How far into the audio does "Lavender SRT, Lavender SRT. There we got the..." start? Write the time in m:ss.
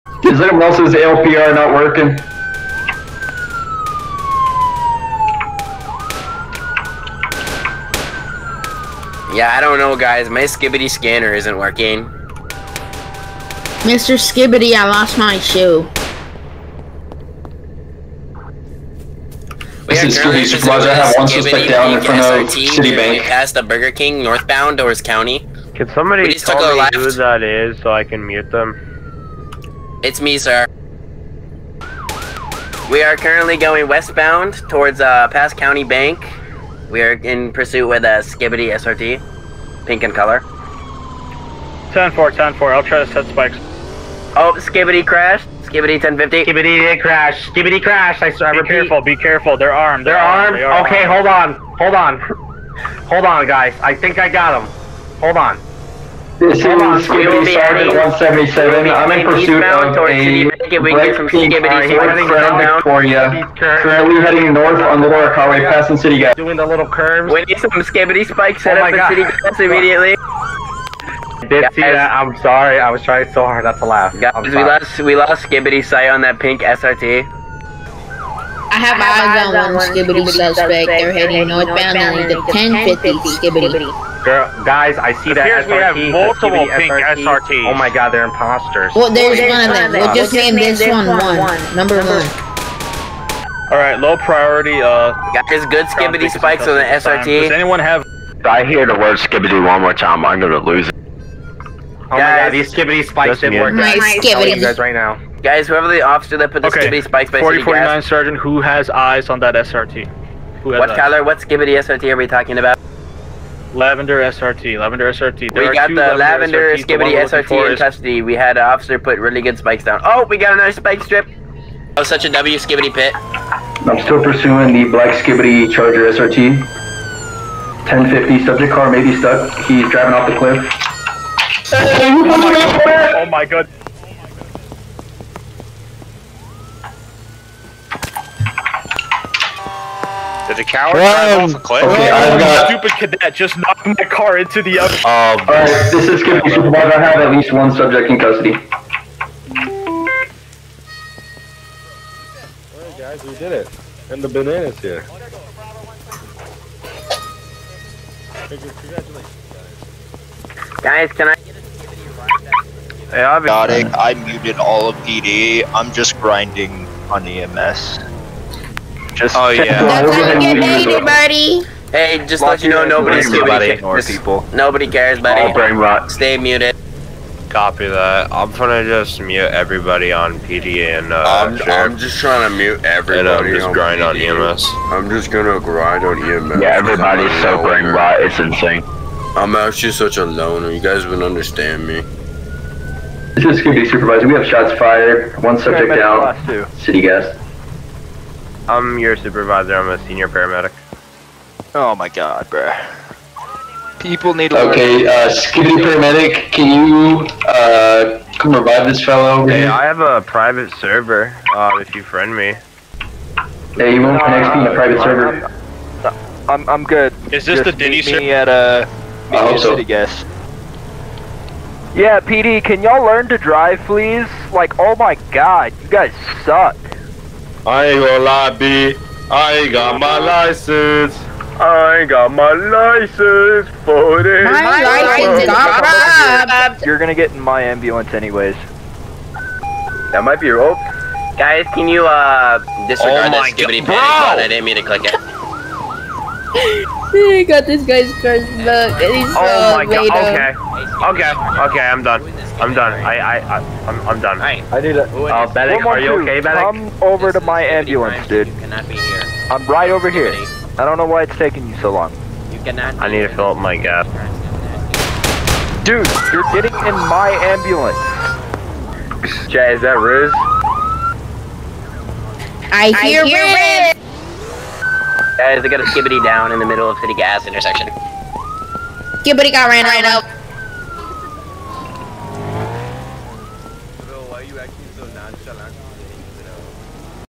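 1:53.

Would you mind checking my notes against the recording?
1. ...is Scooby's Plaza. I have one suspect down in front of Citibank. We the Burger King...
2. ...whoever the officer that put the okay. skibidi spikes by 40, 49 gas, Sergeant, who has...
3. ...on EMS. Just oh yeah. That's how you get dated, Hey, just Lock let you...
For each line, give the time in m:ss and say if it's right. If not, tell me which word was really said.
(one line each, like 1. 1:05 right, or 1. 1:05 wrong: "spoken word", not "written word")
1. 0:20 right
2. 1:45 right
3. 2:47 right.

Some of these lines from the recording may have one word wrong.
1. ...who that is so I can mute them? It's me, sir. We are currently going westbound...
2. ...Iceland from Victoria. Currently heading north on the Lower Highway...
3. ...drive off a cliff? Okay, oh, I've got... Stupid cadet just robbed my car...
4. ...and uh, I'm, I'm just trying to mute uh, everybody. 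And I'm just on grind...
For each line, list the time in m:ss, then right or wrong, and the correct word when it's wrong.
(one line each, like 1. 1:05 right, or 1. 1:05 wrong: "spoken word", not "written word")
1. 0:26 right
2. 1:01 right
3. 2:20 wrong: "knocked", not "robbed"
4. 3:00 right.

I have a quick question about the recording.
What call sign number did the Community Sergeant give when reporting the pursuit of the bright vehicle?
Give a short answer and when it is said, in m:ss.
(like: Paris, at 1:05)
177, at 0:57.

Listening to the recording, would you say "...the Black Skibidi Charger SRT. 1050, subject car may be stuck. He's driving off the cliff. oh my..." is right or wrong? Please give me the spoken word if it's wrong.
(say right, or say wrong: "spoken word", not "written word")
right.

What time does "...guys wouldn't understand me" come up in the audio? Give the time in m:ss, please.
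3:10.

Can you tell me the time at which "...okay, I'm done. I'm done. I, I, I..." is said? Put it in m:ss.
4:11.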